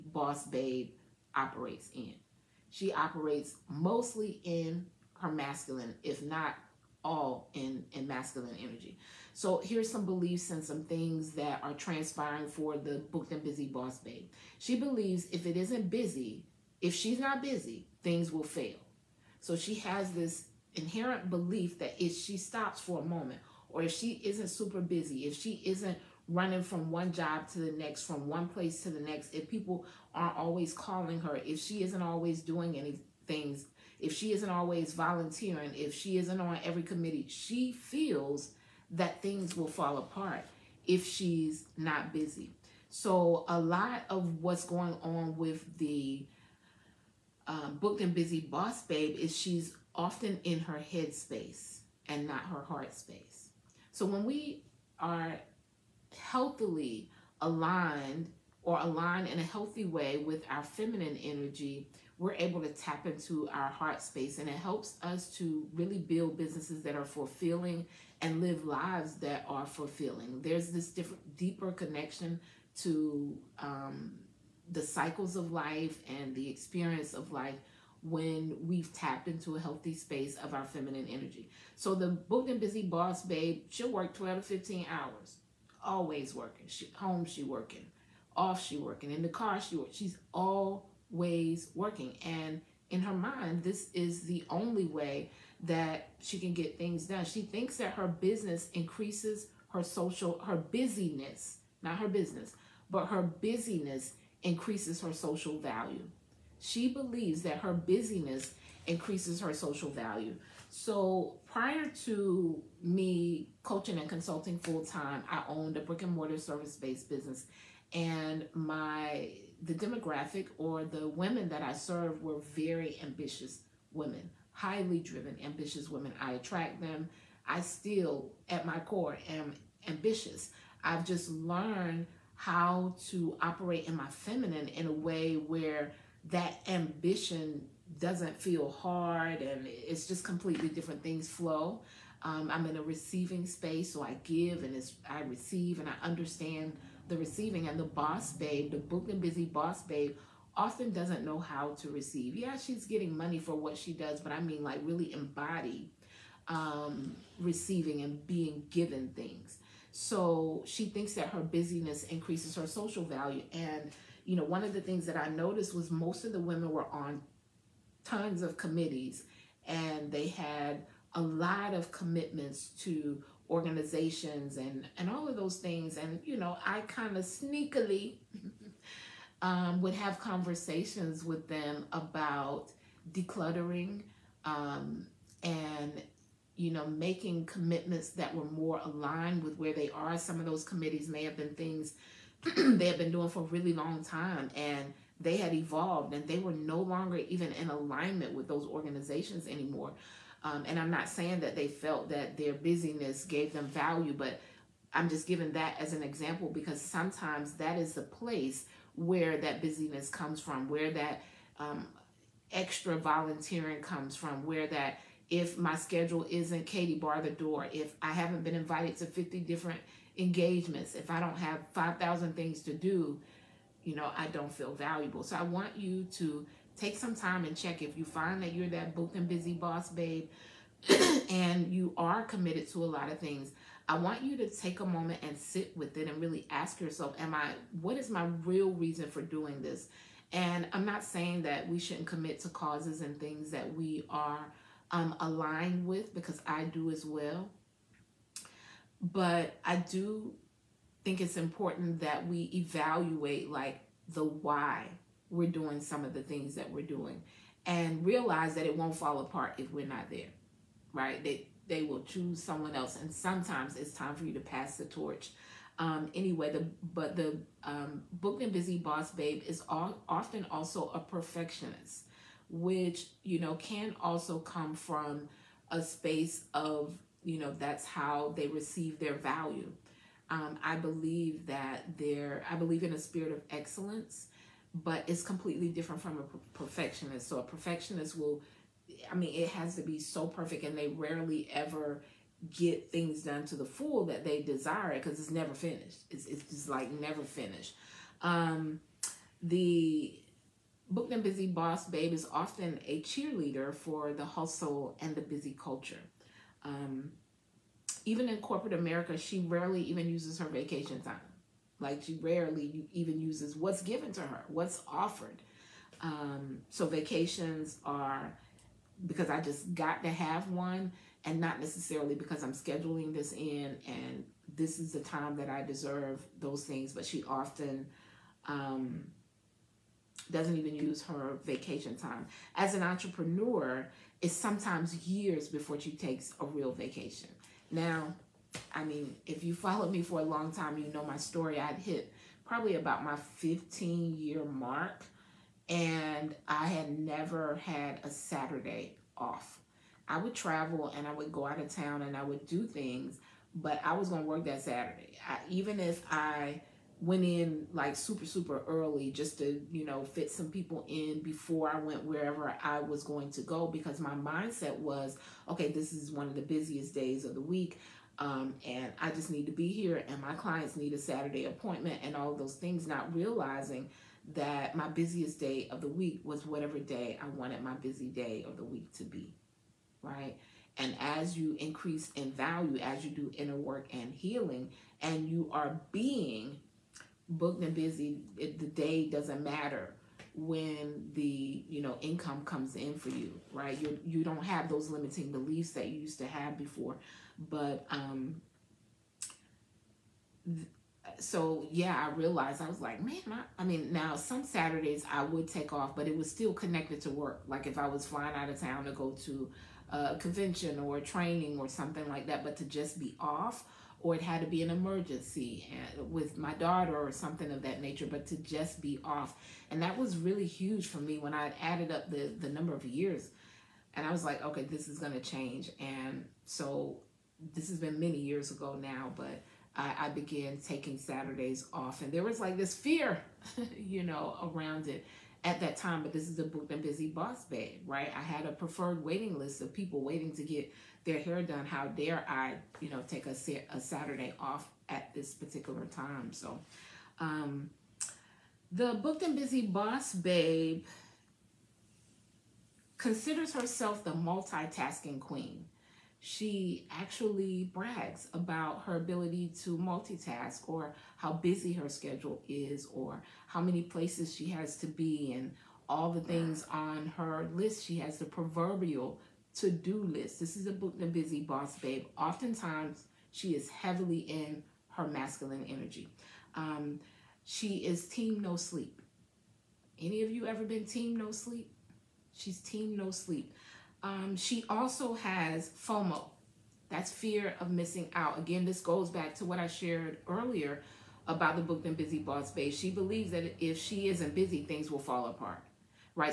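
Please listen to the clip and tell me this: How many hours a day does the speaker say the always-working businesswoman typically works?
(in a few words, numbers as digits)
12 to 15.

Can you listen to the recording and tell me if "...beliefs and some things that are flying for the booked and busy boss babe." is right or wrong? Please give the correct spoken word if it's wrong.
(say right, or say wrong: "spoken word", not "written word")
wrong: "transpiring", not "flying".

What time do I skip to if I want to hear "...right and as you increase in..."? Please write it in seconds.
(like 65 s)
380 s.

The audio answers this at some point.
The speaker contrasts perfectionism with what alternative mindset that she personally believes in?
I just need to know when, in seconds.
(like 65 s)
282 s.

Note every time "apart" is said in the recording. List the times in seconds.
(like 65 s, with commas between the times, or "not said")
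39 s, 259 s, 495 s.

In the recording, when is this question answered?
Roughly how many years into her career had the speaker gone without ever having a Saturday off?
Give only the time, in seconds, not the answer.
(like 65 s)
343 s.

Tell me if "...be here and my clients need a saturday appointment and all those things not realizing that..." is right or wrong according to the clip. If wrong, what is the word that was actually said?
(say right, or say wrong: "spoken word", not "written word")
right.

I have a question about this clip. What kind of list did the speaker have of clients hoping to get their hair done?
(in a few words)
preferred waiting list.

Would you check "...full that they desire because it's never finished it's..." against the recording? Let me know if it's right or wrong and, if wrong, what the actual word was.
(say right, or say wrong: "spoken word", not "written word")
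right.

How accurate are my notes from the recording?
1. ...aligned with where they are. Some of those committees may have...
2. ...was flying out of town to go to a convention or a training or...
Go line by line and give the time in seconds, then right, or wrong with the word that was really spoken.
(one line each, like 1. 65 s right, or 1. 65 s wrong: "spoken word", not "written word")
1. 188 s right
2. 407 s right.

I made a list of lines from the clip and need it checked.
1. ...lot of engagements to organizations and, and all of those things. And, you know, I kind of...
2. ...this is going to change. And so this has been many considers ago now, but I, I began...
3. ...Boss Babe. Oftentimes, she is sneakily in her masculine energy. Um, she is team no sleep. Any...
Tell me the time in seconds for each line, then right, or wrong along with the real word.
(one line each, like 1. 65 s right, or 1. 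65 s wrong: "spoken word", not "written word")
1. 171 s wrong: "commitments", not "engagements"
2. 424 s wrong: "years", not "considers"
3. 471 s wrong: "heavily", not "sneakily".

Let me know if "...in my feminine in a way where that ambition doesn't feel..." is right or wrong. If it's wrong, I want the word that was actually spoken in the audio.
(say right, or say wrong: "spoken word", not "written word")
right.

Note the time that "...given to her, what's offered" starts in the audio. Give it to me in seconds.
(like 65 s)
313 s.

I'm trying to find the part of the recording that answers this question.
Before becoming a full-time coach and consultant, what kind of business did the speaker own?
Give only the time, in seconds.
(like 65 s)
115 s.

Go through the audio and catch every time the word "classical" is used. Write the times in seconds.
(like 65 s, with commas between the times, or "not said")
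not said.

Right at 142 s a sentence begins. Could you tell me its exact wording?
Um, I'm in a receiving space, so I give and I receive and I understand the receiving.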